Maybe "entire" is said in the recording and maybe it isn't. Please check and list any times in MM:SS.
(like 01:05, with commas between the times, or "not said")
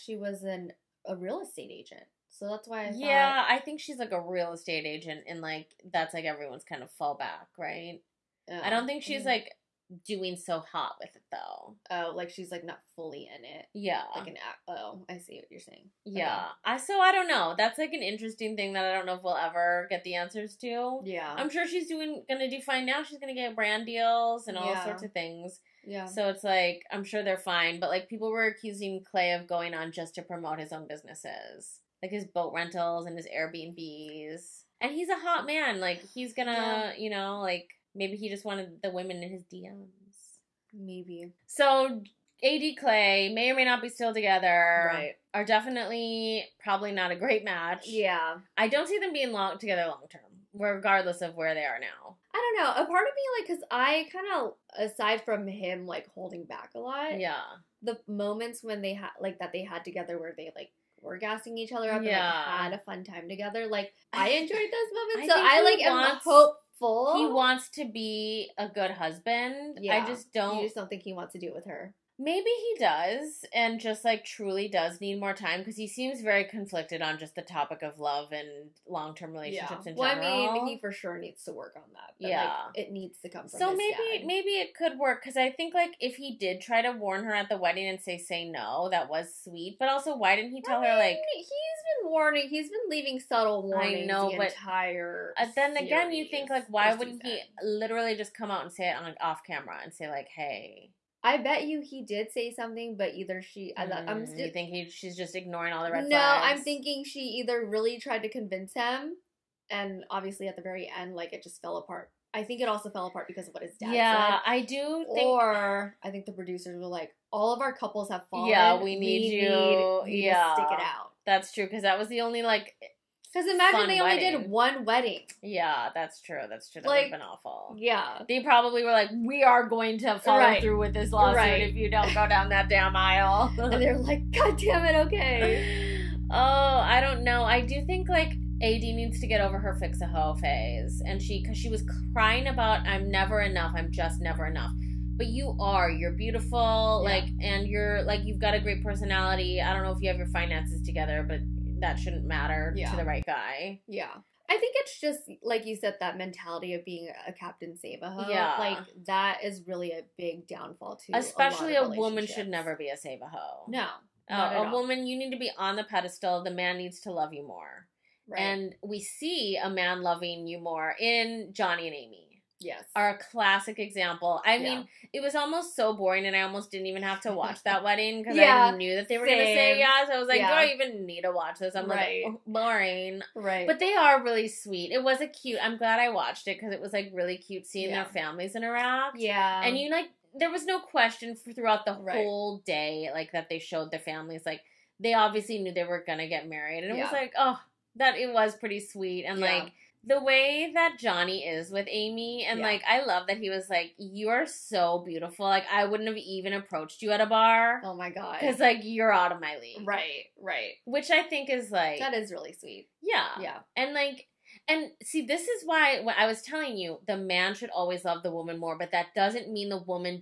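01:34.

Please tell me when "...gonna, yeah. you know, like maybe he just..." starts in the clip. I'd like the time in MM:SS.
00:36.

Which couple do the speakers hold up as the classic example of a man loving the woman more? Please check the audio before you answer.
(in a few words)
Johnny and Amy.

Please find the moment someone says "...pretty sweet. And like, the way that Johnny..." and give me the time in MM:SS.
03:18.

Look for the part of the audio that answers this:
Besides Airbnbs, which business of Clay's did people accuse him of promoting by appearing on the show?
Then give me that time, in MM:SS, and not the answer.
00:32.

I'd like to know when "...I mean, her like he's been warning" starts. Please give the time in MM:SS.
01:30.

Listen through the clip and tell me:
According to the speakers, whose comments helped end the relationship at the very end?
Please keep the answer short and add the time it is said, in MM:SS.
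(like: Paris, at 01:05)
His dad, at 01:53.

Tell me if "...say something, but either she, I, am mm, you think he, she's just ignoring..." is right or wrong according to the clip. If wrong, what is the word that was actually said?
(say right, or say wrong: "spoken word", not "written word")
right.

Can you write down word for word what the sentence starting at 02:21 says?
And she, because she was crying about, I'm never enough.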